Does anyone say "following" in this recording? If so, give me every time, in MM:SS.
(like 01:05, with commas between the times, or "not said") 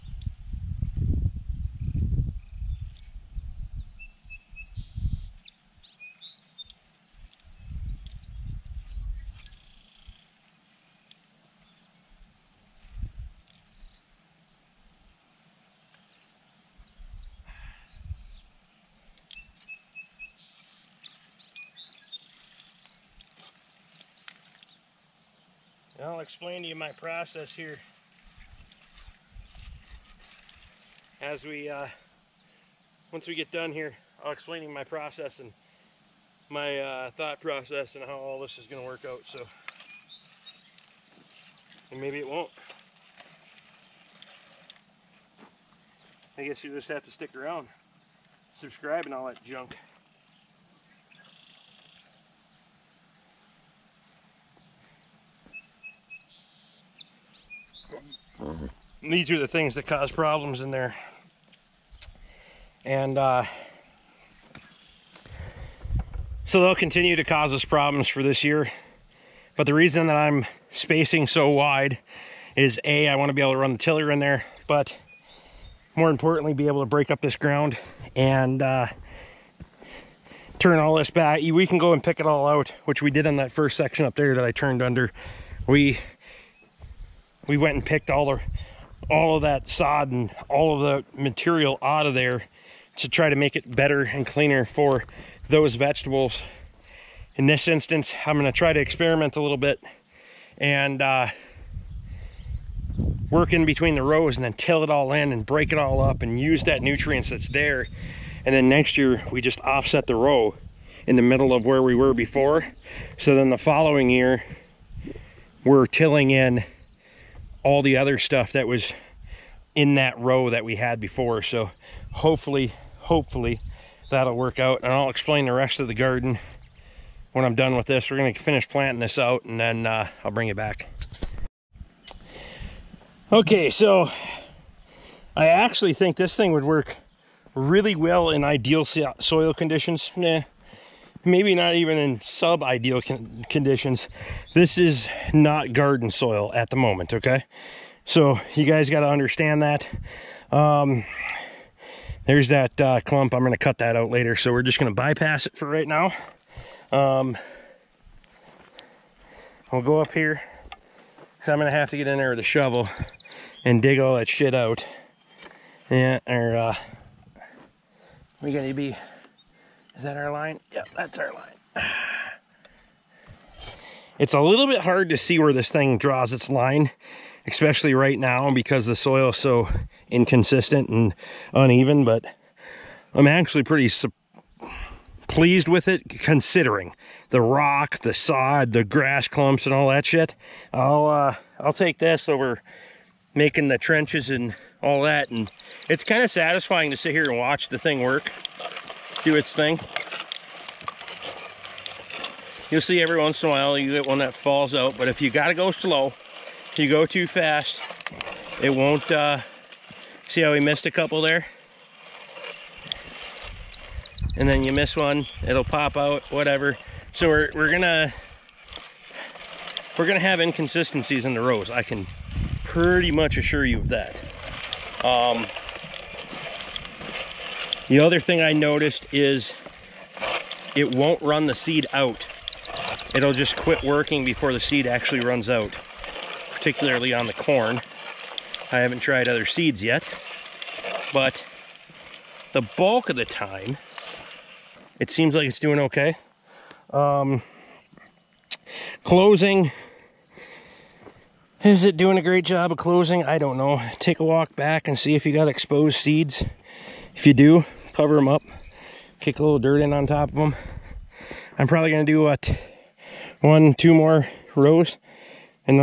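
01:53.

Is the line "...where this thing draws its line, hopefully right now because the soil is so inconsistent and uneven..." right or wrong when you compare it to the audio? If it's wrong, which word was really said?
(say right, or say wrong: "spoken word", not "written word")
wrong: "especially", not "hopefully".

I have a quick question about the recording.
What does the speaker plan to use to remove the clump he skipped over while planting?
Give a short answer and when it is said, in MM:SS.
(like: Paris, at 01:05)
shovel, at 02:42.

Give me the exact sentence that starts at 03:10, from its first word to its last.
I'll, uh, I'll take this over making the trenches and all that.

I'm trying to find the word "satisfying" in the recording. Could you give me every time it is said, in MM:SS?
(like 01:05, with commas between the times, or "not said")
03:16.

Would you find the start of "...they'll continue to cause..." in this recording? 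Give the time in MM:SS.
01:06.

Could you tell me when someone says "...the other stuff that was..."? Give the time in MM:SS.
01:57.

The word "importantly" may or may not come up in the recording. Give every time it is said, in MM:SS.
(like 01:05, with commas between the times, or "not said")
01:16.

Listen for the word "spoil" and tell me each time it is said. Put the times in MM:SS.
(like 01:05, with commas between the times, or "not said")
not said.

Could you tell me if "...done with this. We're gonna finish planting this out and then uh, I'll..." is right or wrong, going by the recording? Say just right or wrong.
right.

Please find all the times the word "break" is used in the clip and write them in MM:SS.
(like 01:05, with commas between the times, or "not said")
01:16, 01:45.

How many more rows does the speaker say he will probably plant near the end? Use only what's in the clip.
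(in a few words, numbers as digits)
2.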